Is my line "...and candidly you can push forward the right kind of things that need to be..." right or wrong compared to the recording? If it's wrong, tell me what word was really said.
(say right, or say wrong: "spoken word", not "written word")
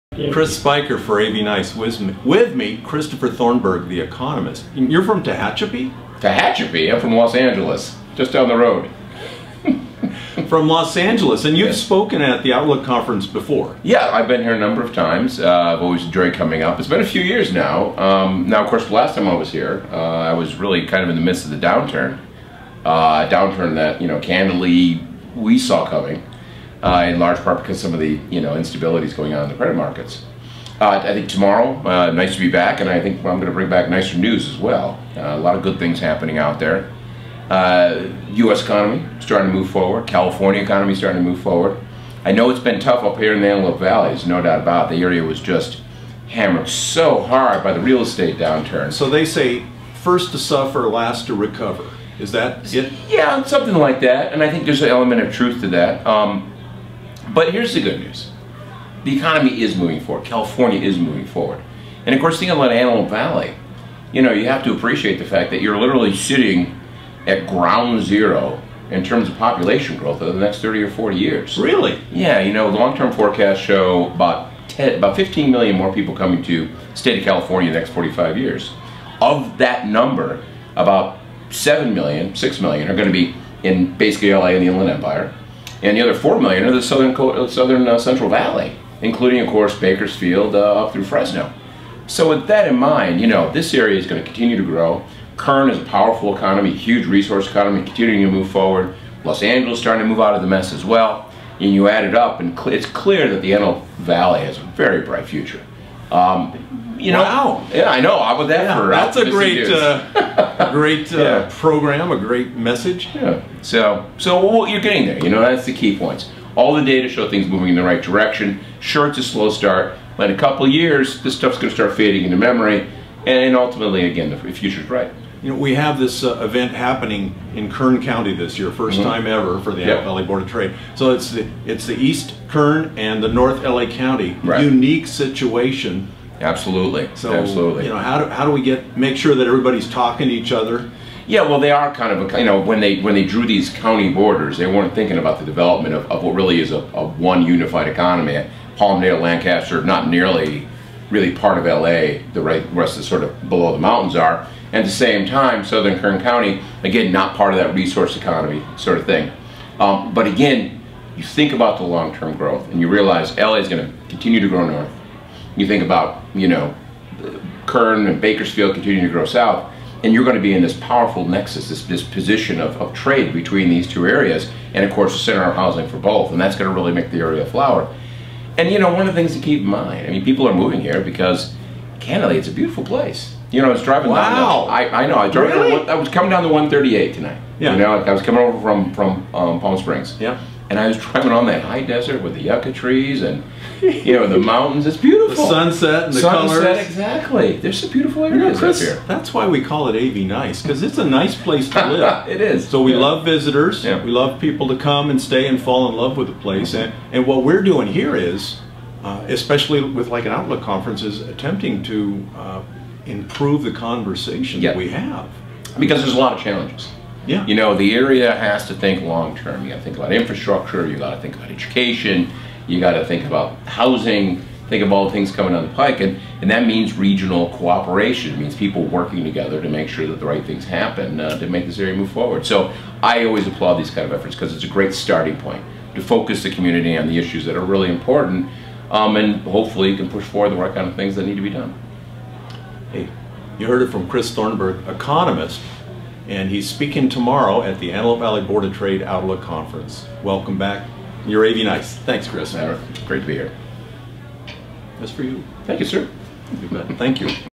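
wrong: "hopefully", not "candidly".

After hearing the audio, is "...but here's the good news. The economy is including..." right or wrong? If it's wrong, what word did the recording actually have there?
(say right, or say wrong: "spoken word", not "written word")
wrong: "moving", not "including".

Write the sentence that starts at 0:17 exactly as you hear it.
Um, now, of course, the last time I was here, uh, I was really kind of in the midst of the downturn.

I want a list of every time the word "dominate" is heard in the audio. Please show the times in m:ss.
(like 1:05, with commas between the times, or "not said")
not said.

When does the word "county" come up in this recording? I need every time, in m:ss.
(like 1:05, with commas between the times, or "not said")
2:08, 2:13, 2:23, 2:36.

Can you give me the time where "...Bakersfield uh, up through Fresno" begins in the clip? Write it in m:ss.
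1:29.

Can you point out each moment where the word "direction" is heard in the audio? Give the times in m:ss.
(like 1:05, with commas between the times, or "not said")
1:58.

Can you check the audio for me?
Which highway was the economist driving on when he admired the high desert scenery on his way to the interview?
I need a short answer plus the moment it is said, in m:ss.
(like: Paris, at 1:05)
the 138, at 3:06.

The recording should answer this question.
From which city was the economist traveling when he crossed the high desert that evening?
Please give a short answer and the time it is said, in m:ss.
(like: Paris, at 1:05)
Palm Springs, at 3:09.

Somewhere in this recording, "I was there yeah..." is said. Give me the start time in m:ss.
1:48.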